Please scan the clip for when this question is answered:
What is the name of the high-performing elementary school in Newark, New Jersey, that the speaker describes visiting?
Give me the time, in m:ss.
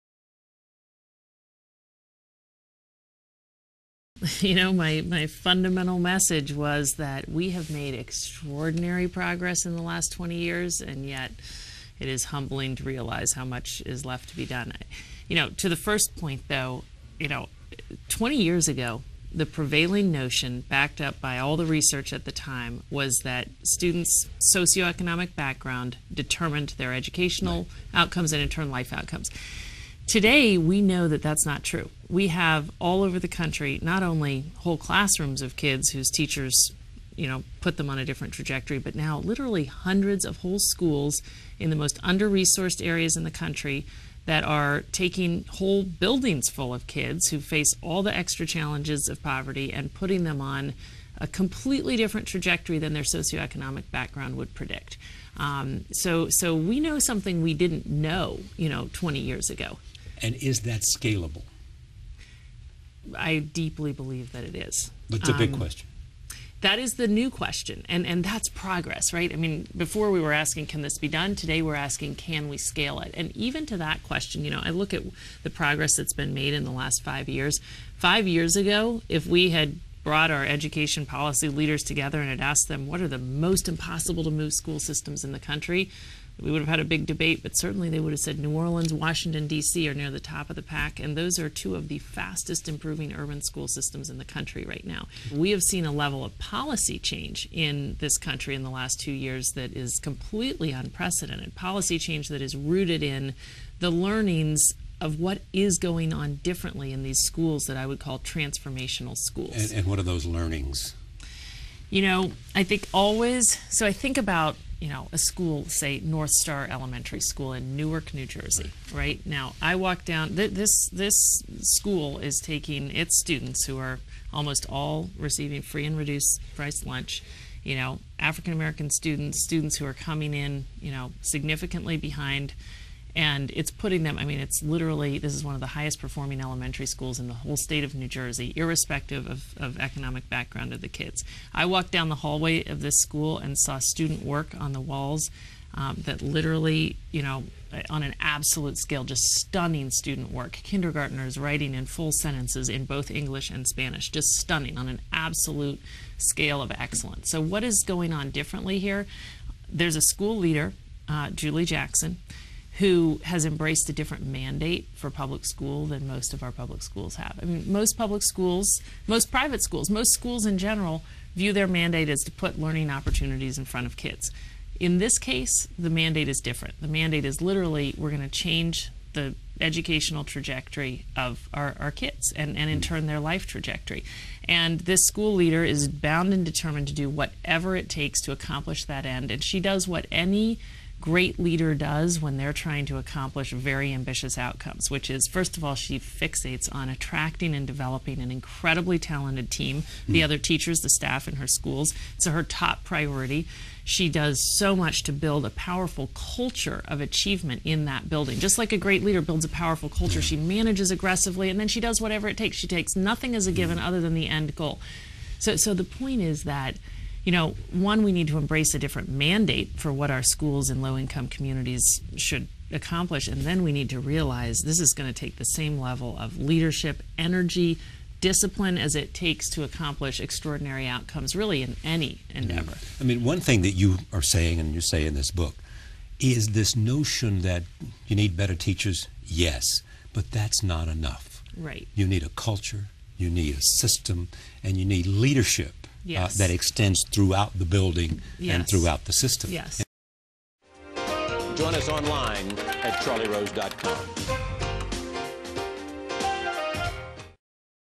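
1:56.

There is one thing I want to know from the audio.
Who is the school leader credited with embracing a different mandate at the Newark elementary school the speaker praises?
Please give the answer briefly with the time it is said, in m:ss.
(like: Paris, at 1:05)
Julie Jackson, at 2:41.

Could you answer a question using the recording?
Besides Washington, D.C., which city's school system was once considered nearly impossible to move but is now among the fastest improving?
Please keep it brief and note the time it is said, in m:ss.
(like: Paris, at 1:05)
New Orleans, at 1:28.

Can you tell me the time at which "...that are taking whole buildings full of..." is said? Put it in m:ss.
0:44.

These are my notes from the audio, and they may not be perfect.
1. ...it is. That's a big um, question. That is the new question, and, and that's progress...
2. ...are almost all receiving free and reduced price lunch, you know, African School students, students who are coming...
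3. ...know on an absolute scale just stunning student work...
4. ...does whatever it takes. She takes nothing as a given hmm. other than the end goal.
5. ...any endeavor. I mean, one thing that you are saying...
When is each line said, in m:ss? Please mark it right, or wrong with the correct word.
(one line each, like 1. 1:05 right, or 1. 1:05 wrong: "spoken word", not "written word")
1. 1:04 right
2. 2:03 wrong: "American", not "School"
3. 2:27 right
4. 3:31 right
5. 3:51 right.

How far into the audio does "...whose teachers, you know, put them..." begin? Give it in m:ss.
0:35.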